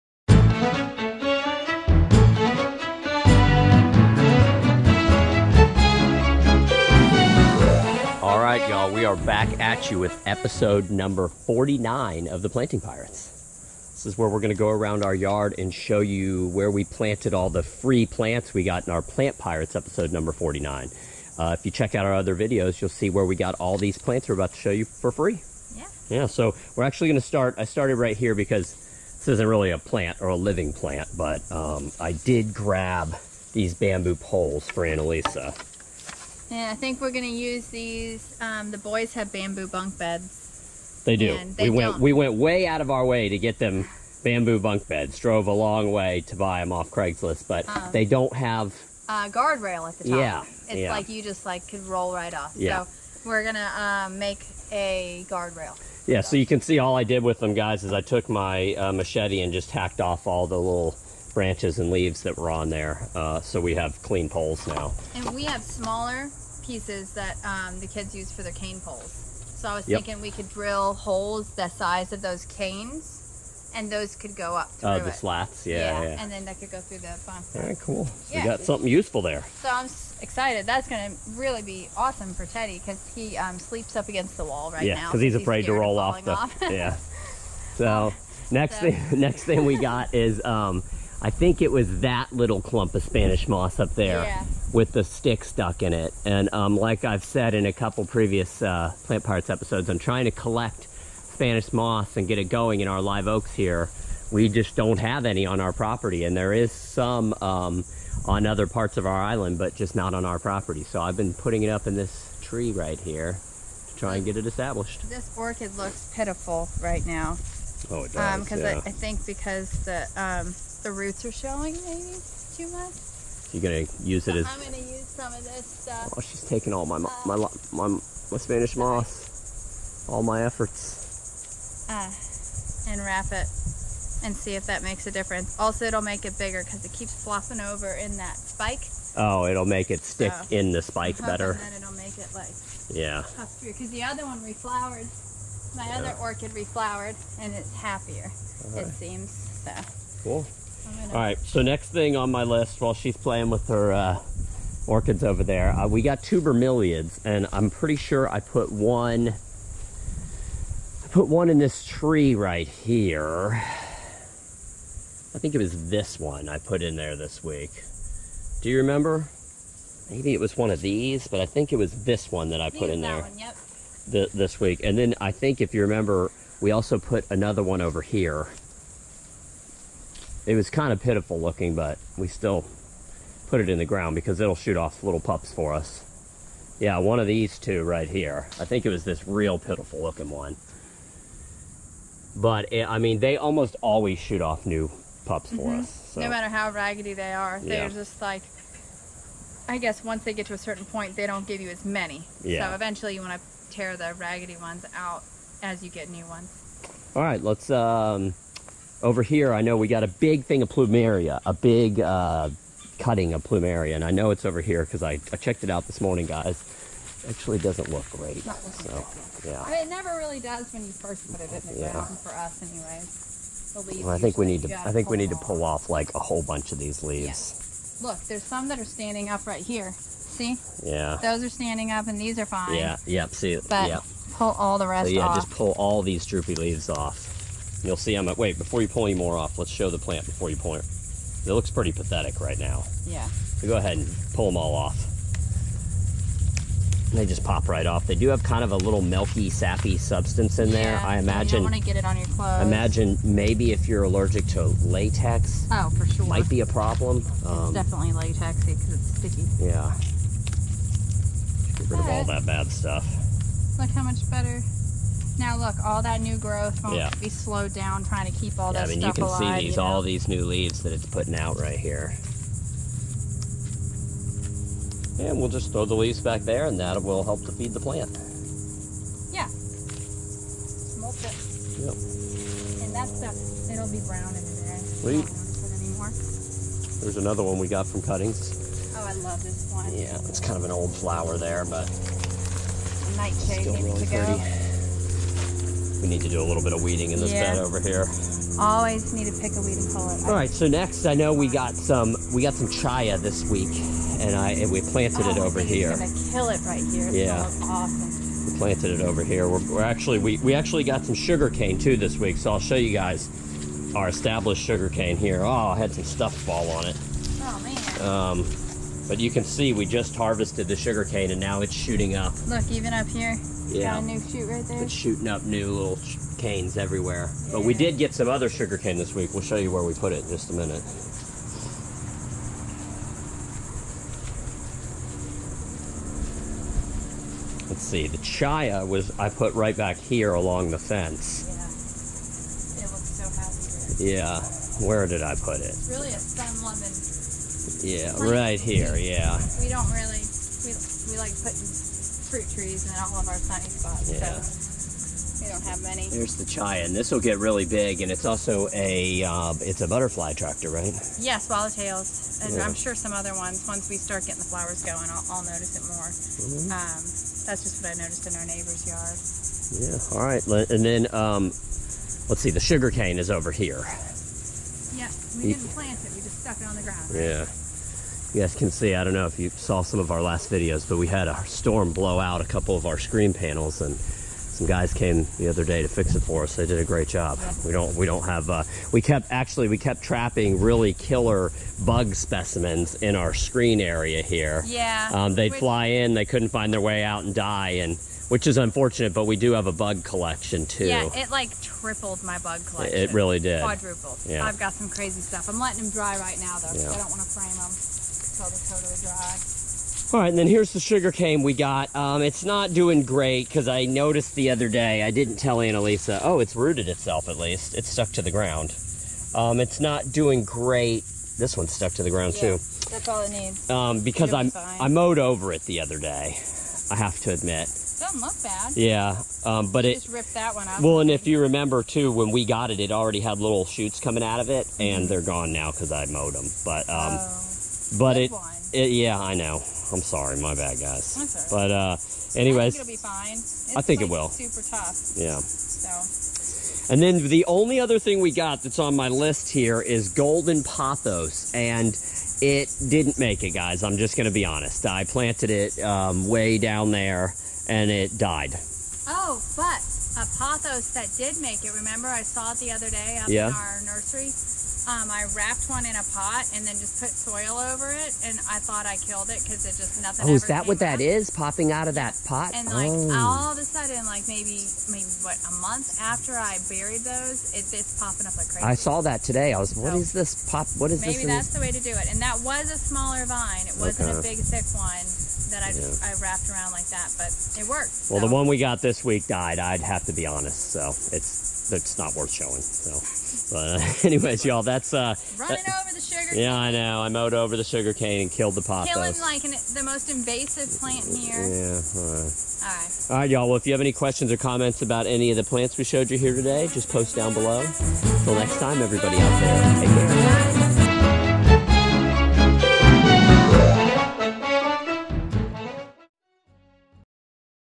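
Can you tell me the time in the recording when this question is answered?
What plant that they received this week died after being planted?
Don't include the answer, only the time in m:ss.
7:30.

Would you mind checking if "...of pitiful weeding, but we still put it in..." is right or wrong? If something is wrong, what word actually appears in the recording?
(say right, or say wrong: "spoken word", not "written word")
wrong: "looking", not "weeding".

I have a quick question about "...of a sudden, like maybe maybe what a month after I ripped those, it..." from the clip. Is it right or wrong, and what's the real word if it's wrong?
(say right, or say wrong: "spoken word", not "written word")
wrong: "buried", not "ripped".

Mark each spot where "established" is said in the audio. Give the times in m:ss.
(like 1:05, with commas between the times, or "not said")
1:54, 5:14.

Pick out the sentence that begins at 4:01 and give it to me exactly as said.
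It looks pretty pathetic right now.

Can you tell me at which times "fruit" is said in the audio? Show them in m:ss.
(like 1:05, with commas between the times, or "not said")
5:52.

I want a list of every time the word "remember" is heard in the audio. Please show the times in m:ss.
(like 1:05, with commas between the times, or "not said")
2:48, 2:55, 7:11, 7:41.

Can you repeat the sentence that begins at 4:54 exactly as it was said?
Go we need to do a little bit of weeding in this yeah.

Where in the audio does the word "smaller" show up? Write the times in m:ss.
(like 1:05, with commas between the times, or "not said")
1:05, 8:02.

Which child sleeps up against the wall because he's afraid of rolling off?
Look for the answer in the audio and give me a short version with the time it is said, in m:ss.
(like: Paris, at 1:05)
Teddy, at 1:22.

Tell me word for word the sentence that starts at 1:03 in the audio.
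Uh, so we have clean poles now.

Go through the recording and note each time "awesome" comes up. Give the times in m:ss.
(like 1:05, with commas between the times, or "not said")
1:21, 5:07.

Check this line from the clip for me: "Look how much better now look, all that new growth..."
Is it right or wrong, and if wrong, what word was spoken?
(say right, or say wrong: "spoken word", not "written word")
right.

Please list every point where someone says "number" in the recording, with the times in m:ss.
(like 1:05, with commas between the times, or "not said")
0:10, 0:20.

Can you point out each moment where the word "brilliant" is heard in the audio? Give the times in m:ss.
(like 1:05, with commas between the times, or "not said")
not said.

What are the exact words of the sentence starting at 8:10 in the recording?
So it's that's not worth showing.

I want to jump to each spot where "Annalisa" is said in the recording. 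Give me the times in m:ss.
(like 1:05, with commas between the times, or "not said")
0:34, 6:55.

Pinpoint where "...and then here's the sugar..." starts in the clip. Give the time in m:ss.
6:50.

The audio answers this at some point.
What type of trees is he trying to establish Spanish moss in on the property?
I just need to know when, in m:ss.
1:43.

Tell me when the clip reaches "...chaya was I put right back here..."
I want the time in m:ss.
5:38.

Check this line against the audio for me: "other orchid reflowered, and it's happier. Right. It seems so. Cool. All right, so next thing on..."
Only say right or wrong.
right.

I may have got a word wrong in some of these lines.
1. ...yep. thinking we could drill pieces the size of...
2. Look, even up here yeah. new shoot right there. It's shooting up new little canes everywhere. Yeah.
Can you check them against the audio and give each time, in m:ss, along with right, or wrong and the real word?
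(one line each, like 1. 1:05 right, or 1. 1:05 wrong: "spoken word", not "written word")
1. 1:09 wrong: "holes", not "pieces"
2. 5:22 right.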